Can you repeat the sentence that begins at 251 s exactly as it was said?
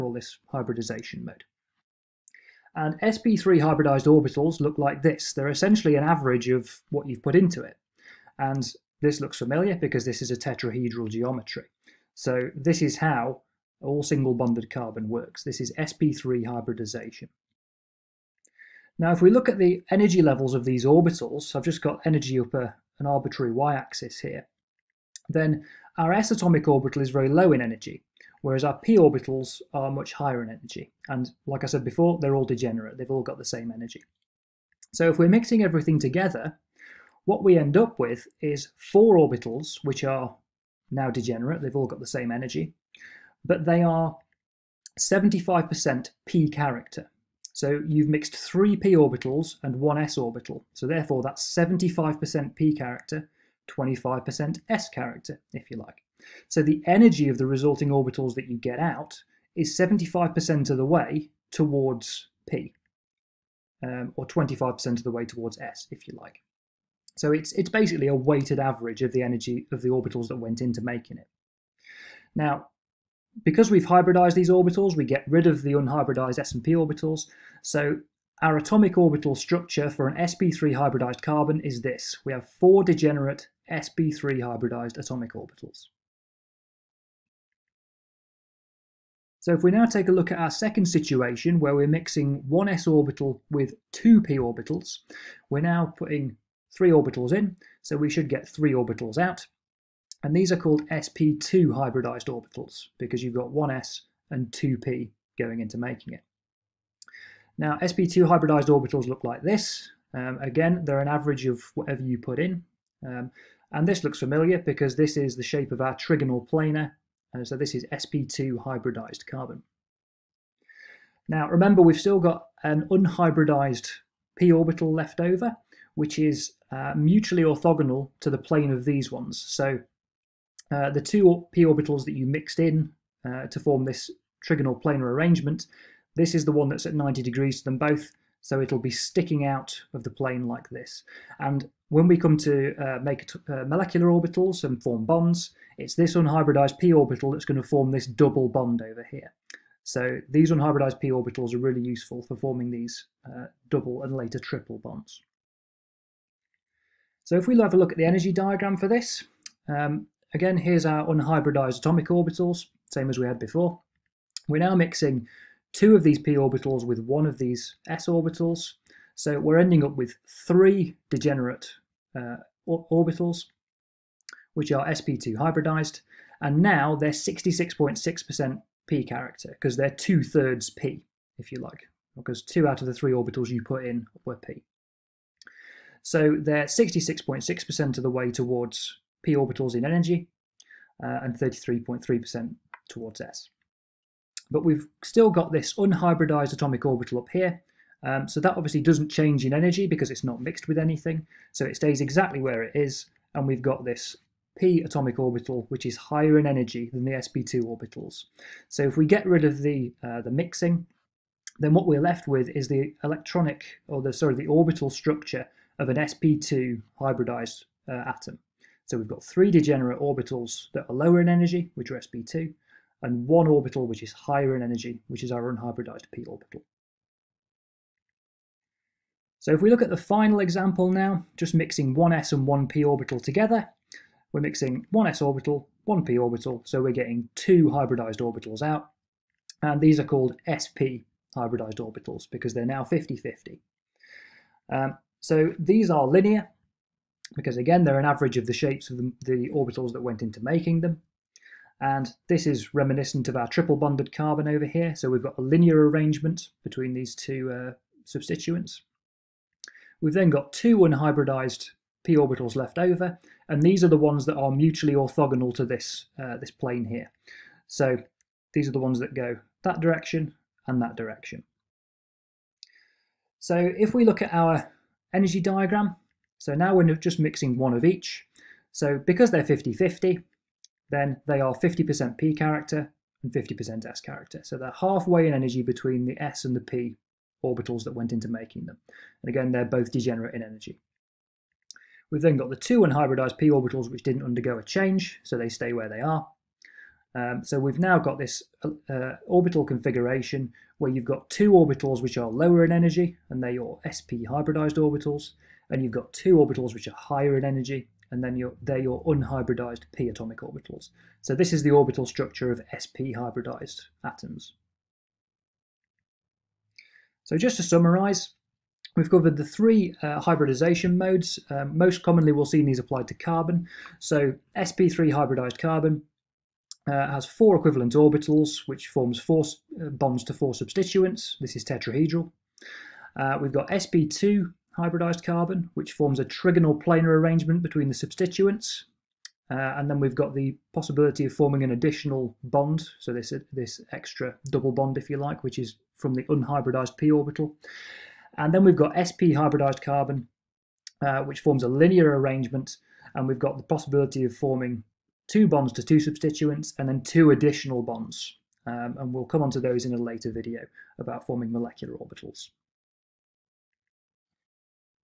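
And this is reminiscent of our triple bonded carbon over here.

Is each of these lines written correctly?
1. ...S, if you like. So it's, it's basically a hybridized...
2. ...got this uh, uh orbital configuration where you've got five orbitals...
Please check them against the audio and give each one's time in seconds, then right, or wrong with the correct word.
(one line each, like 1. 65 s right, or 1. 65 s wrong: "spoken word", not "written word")
1. 65 s wrong: "weighted", not "hybridized"
2. 297 s wrong: "two", not "five".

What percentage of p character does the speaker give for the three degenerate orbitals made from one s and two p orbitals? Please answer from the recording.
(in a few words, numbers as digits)
66.6%.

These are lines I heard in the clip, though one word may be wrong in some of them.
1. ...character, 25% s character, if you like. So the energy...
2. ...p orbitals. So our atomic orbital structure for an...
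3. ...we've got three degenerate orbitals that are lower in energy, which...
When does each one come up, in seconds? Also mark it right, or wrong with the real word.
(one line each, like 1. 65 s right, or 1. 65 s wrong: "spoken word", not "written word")
1. 52 s right
2. 76 s right
3. 218 s right.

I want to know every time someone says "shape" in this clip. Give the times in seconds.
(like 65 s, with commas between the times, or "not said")
115 s, 248 s.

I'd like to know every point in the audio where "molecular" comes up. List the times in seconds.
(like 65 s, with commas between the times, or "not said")
143 s, 361 s.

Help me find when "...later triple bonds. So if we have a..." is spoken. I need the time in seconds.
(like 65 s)
154 s.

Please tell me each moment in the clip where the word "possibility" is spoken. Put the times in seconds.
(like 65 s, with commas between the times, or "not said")
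340 s, 353 s.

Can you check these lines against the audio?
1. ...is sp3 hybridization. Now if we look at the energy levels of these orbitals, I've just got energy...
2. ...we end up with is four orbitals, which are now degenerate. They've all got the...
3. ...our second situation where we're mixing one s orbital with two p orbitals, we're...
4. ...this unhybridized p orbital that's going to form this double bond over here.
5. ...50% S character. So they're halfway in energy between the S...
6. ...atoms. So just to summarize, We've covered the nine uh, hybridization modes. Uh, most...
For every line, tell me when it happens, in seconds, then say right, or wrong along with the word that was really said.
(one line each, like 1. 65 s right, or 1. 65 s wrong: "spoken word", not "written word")
1. 15 s right
2. 37 s right
3. 90 s right
4. 145 s right
5. 283 s right
6. 314 s wrong: "three", not "nine".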